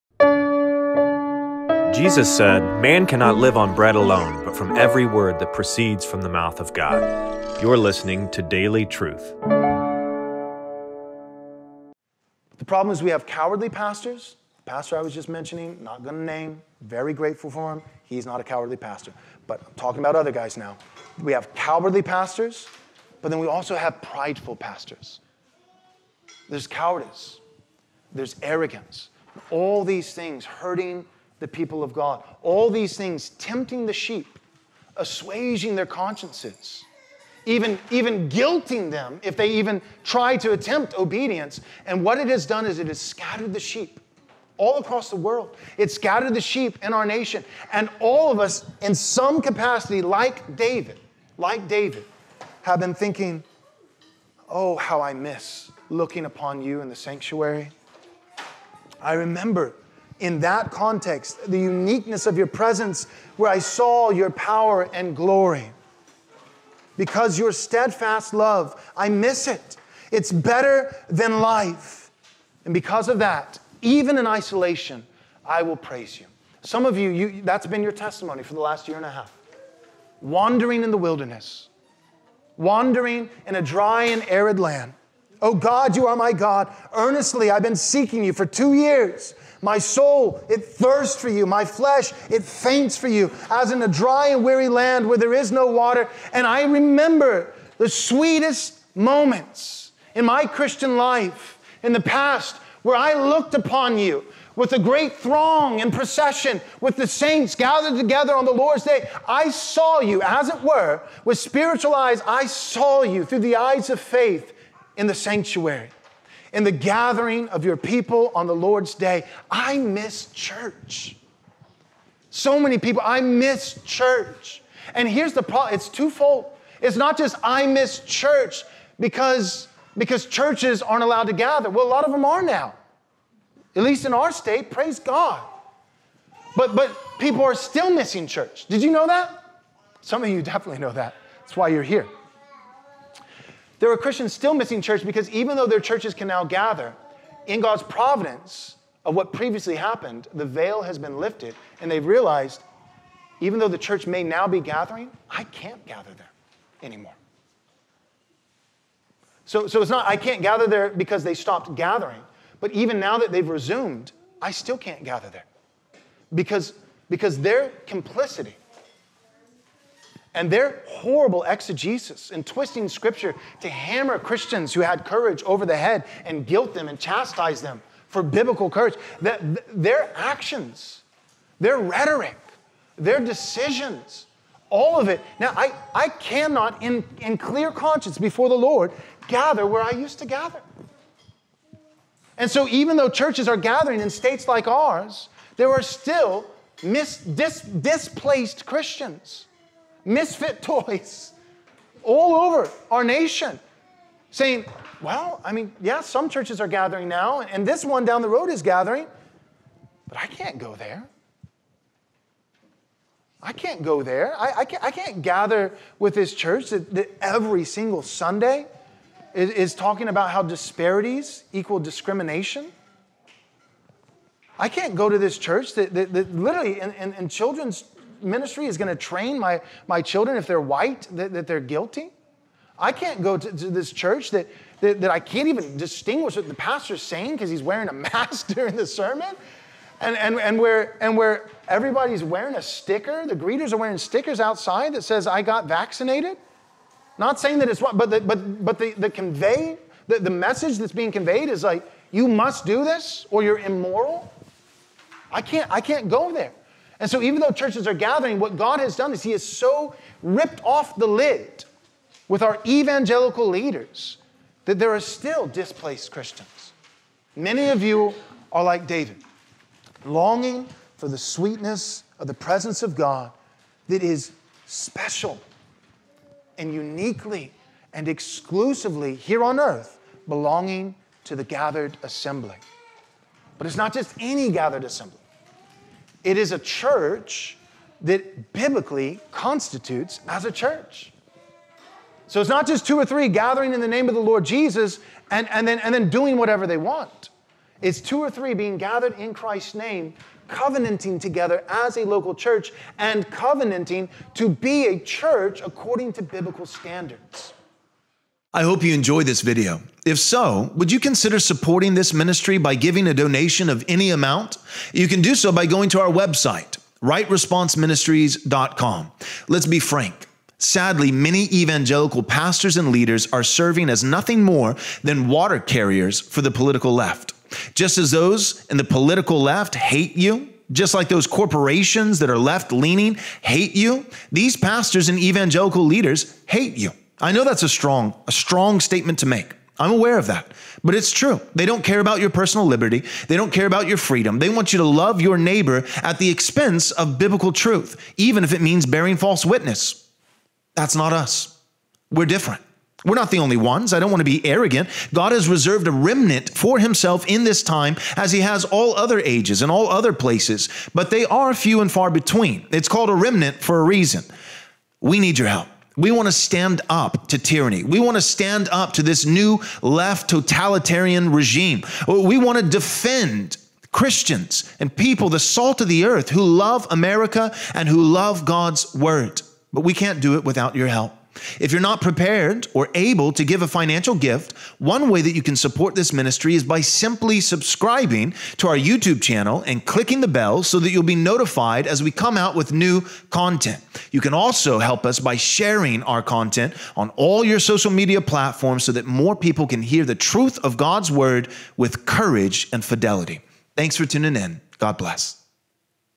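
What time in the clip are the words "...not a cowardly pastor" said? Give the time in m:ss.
0:18.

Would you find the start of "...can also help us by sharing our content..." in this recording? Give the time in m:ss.
6:34.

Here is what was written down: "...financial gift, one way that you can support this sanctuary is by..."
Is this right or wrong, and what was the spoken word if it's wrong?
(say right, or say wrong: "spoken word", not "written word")
wrong: "ministry", not "sanctuary".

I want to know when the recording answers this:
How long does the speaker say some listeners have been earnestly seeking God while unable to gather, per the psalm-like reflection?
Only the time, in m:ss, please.
1:28.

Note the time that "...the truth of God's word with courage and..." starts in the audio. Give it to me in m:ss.
6:40.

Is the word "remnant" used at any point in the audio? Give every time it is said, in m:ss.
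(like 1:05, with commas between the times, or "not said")
5:55, 6:03.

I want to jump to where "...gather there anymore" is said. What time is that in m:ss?
2:35.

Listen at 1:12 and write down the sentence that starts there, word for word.
And because of that, even in isolation, I will praise you.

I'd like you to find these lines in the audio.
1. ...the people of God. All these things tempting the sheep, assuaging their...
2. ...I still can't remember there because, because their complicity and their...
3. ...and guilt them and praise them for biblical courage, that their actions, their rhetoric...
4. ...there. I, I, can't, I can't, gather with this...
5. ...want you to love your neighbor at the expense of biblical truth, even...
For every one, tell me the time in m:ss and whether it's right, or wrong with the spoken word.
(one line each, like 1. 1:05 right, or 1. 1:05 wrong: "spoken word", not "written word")
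1. 0:31 right
2. 2:44 wrong: "gather", not "remember"
3. 2:56 wrong: "chastise", not "praise"
4. 3:34 right
5. 5:44 right.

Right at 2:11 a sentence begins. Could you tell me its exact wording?
Well, a lot of them are now, at least in our state, praise God.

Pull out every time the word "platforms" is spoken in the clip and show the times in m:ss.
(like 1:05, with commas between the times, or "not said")
6:38.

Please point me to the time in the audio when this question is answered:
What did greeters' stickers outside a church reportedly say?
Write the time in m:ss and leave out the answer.
4:05.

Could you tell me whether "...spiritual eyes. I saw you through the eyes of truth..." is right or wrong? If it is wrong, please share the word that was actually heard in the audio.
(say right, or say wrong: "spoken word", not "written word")
wrong: "faith", not "truth".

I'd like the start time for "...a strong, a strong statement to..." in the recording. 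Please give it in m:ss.
5:37.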